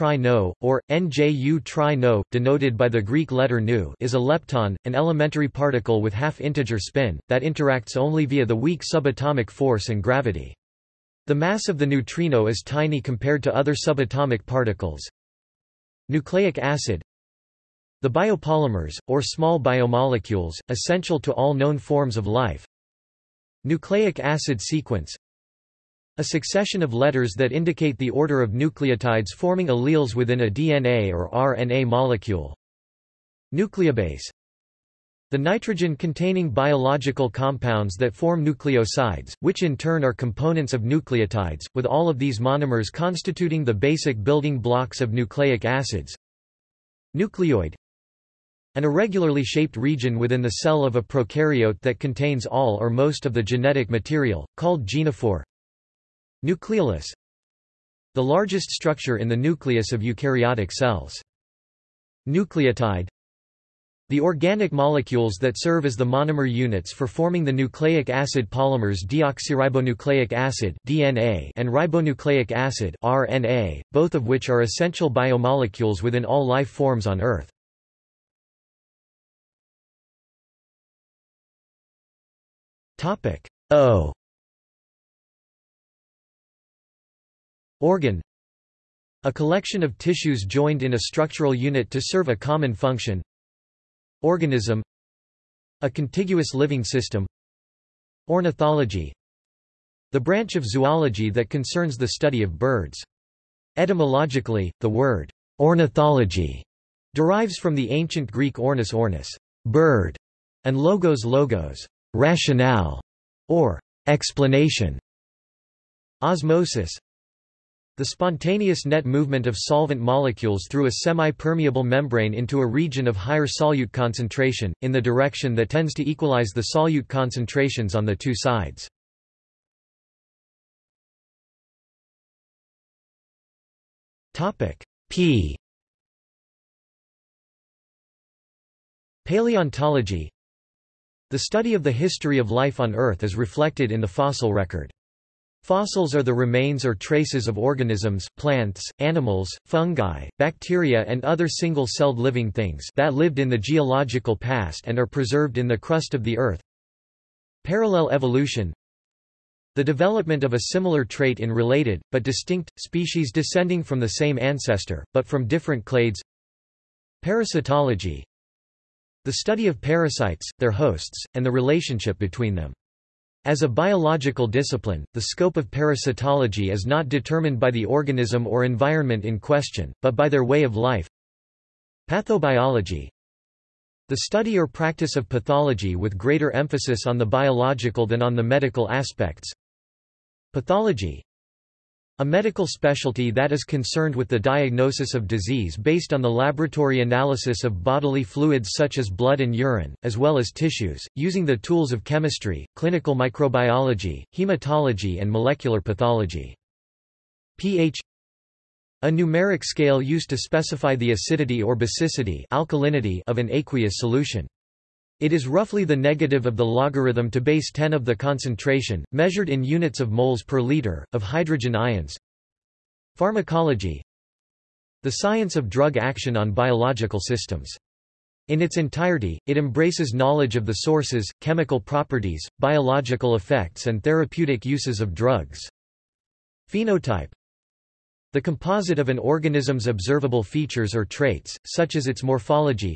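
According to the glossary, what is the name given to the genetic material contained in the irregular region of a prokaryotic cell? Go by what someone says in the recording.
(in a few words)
genophore.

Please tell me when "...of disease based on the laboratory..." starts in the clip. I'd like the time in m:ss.
3:15.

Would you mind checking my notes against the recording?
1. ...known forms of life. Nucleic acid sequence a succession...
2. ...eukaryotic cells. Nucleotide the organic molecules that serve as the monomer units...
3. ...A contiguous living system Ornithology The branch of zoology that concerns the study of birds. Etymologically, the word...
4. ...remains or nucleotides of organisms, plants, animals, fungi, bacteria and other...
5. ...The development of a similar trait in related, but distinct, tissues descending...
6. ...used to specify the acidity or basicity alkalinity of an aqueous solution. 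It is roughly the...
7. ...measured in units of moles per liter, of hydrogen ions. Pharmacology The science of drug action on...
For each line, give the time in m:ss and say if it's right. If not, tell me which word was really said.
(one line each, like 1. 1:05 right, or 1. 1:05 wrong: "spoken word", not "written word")
1. 0:21 right
2. 1:00 right
3. 1:35 right
4. 2:26 wrong: "traces", not "nucleotides"
5. 2:39 wrong: "species", not "tissues"
6. 3:29 right
7. 3:39 right.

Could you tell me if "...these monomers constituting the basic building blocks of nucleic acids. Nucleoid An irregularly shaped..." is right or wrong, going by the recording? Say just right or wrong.
right.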